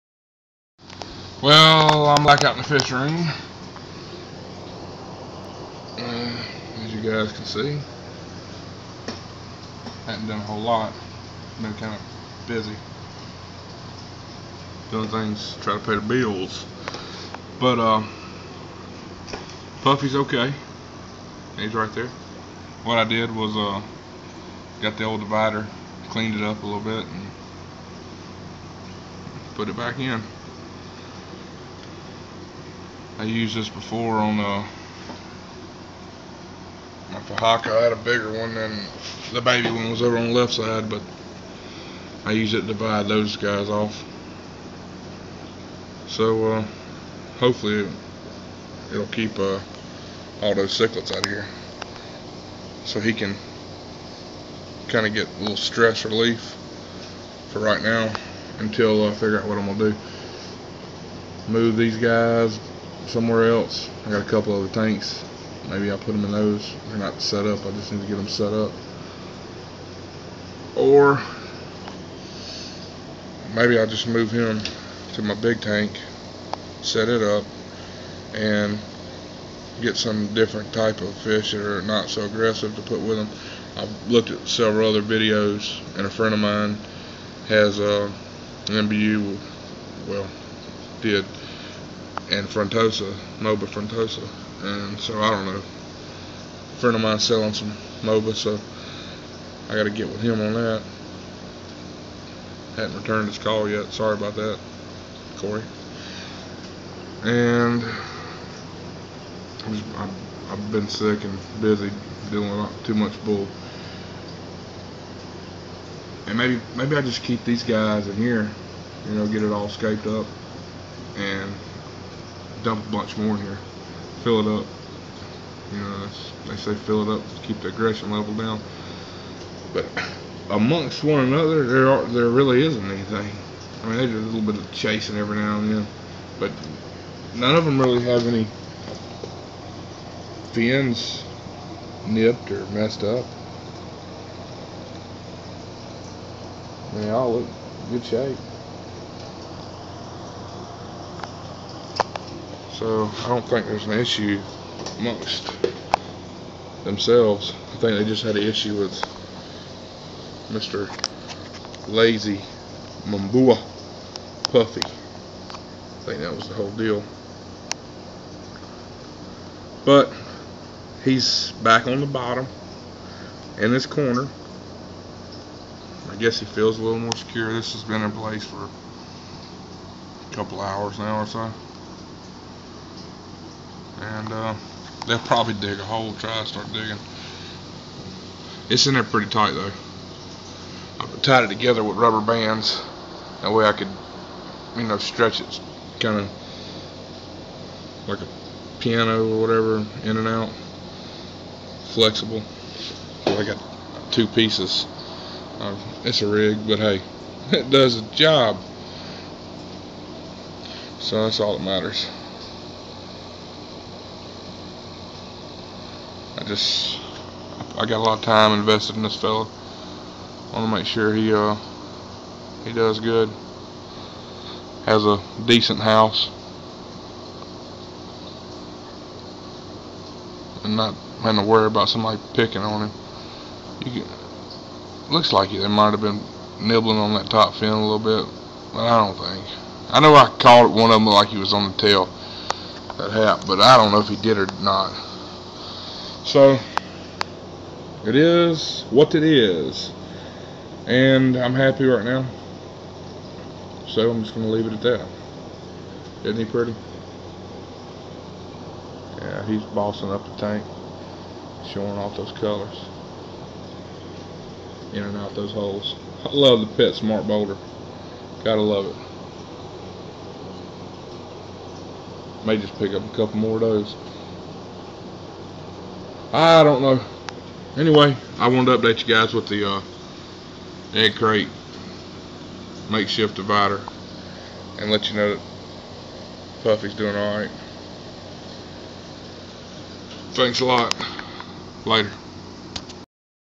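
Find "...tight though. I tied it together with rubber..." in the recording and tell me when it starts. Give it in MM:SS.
03:09.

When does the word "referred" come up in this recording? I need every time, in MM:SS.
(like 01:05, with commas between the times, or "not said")
not said.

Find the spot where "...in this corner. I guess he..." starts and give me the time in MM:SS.
02:53.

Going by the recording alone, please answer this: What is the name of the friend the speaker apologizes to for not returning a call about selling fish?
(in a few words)
Corey.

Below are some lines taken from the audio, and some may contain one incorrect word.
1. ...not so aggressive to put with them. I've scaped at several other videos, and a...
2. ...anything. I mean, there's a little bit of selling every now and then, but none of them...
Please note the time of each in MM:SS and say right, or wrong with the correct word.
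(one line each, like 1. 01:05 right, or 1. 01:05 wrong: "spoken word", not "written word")
1. 01:21 wrong: "looked", not "scaped"
2. 02:12 wrong: "chasing", not "selling".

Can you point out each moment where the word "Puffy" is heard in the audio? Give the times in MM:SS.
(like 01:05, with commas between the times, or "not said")
00:19, 02:44, 04:46.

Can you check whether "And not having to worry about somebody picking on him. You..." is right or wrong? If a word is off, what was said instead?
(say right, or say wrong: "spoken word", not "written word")
right.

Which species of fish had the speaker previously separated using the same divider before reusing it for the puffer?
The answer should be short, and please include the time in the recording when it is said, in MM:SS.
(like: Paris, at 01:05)
Fahaka, at 00:37.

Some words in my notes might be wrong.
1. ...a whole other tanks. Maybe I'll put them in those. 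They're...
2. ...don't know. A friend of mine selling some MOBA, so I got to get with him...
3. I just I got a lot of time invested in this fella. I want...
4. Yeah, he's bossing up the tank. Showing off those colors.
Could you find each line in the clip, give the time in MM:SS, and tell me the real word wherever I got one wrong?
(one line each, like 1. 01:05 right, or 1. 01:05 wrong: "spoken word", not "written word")
1. 01:04 wrong: "couple", not "whole"
2. 01:35 right
3. 03:36 right
4. 04:19 right.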